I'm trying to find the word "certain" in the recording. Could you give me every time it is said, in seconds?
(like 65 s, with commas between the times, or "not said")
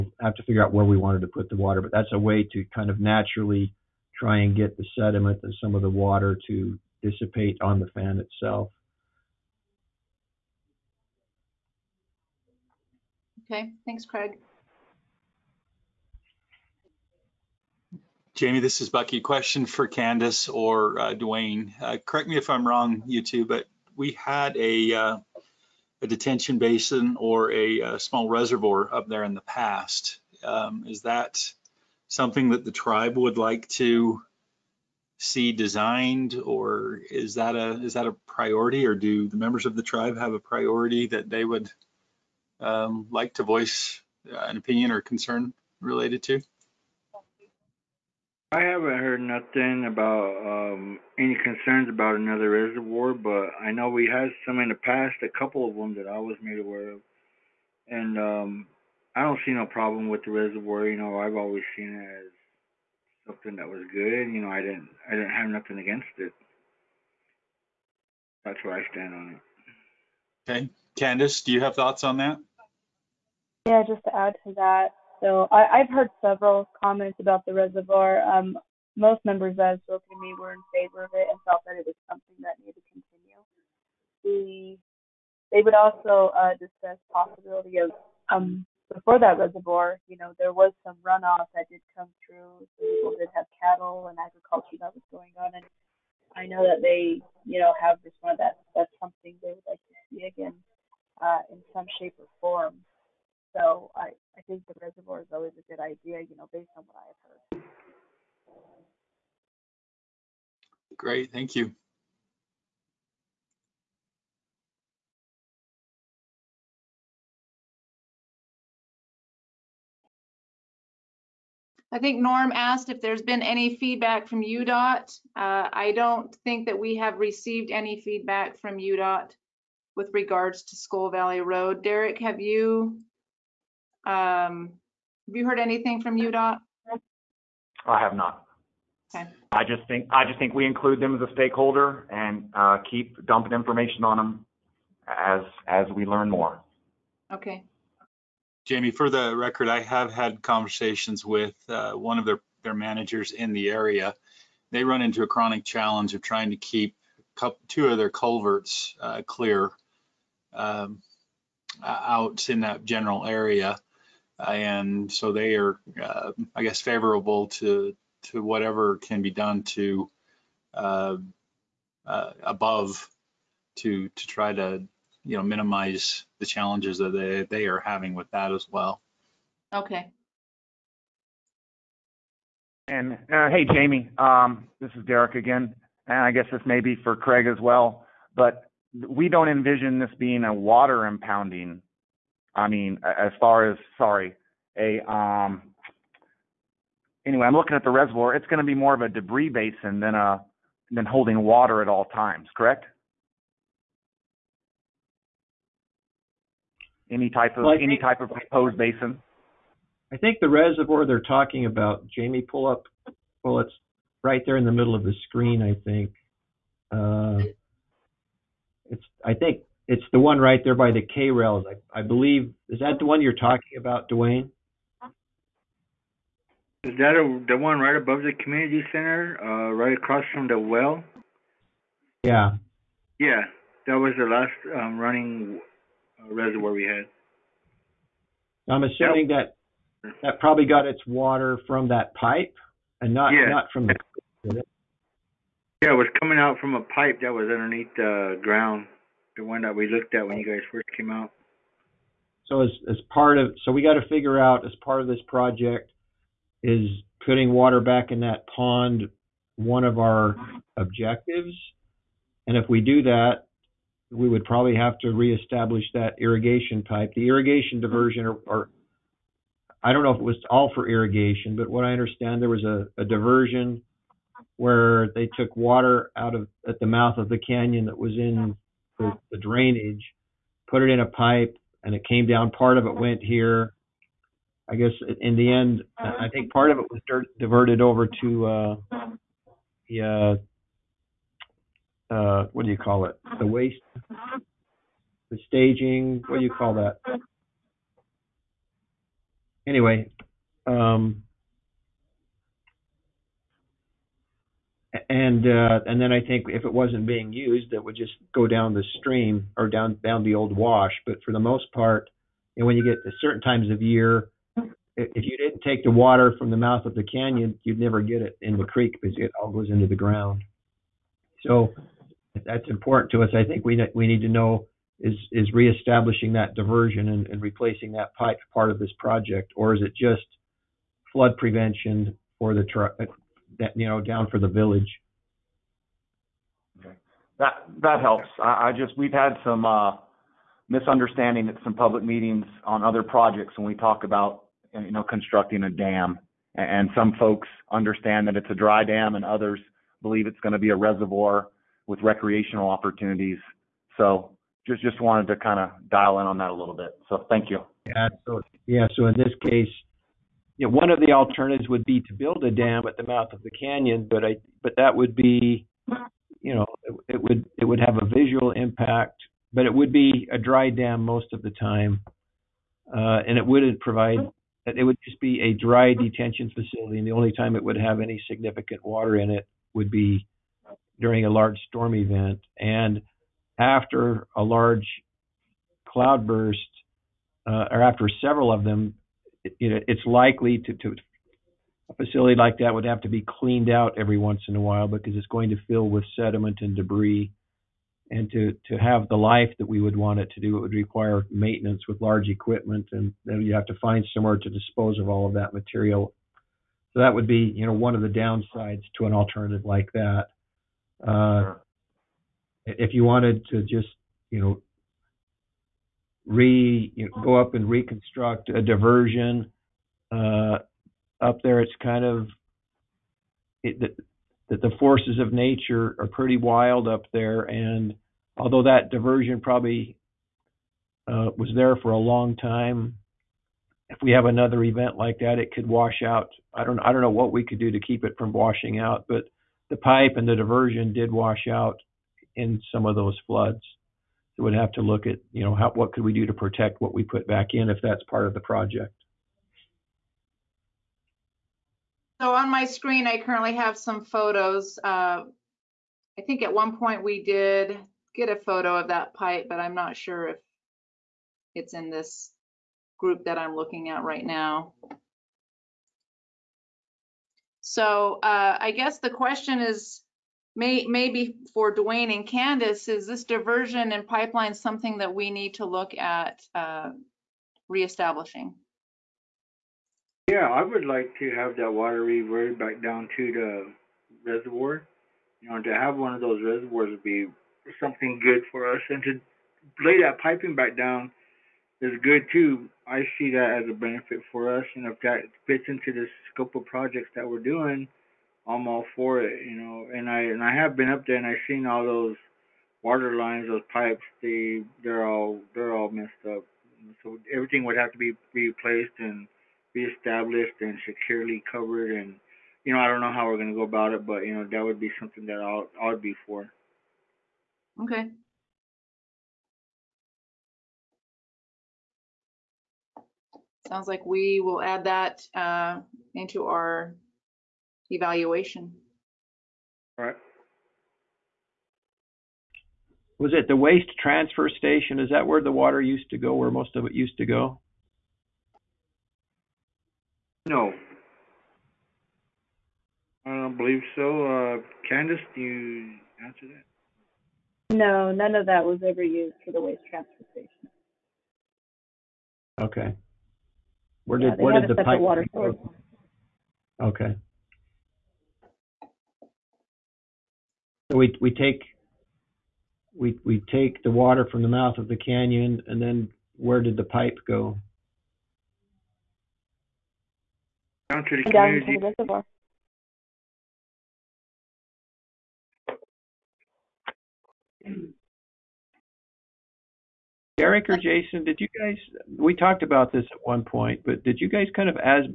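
313 s.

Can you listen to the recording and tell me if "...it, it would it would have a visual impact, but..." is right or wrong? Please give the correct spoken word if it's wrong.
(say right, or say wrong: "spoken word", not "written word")
right.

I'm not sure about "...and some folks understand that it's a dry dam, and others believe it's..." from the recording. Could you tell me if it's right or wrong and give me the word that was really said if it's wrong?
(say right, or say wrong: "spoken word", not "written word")
right.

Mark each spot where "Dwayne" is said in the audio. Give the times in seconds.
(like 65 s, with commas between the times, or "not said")
21 s, 224 s, 471 s.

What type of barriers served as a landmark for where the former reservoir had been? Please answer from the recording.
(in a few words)
K rails.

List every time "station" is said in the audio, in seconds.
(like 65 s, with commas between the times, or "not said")
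534 s, 550 s.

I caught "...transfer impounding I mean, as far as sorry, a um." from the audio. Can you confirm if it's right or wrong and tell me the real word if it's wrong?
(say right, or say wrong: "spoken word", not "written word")
wrong: "water", not "transfer".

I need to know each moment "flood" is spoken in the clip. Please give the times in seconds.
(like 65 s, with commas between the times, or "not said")
331 s, 443 s.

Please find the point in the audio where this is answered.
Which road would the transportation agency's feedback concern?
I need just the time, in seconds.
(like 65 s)
130 s.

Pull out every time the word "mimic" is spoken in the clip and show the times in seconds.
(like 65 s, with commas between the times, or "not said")
not said.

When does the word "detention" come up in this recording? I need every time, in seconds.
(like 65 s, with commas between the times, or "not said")
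26 s, 375 s.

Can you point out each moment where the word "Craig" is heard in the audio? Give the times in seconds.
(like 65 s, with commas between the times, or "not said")
14 s, 187 s.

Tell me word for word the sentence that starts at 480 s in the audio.
Yeah, I would like to have that water reverted back down to the reservoir.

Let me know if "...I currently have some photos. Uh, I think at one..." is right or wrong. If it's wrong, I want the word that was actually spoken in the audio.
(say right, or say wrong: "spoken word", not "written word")
right.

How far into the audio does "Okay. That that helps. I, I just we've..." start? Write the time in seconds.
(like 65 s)
336 s.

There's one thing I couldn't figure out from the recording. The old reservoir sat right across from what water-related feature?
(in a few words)
the well.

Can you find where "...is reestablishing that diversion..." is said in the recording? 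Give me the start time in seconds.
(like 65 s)
325 s.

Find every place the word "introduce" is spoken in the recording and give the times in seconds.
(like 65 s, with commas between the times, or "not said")
not said.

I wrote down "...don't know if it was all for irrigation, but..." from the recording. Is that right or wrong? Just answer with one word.
right.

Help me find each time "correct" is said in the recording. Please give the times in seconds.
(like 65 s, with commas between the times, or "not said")
21 s, 202 s.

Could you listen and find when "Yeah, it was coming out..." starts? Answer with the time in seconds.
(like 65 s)
245 s.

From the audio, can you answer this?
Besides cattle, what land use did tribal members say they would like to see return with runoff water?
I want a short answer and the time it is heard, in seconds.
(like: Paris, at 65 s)
agriculture, at 94 s.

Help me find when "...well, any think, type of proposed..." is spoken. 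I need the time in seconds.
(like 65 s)
207 s.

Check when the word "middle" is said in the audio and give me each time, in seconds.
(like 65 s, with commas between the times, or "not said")
214 s.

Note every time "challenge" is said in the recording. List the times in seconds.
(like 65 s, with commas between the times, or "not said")
155 s, 176 s.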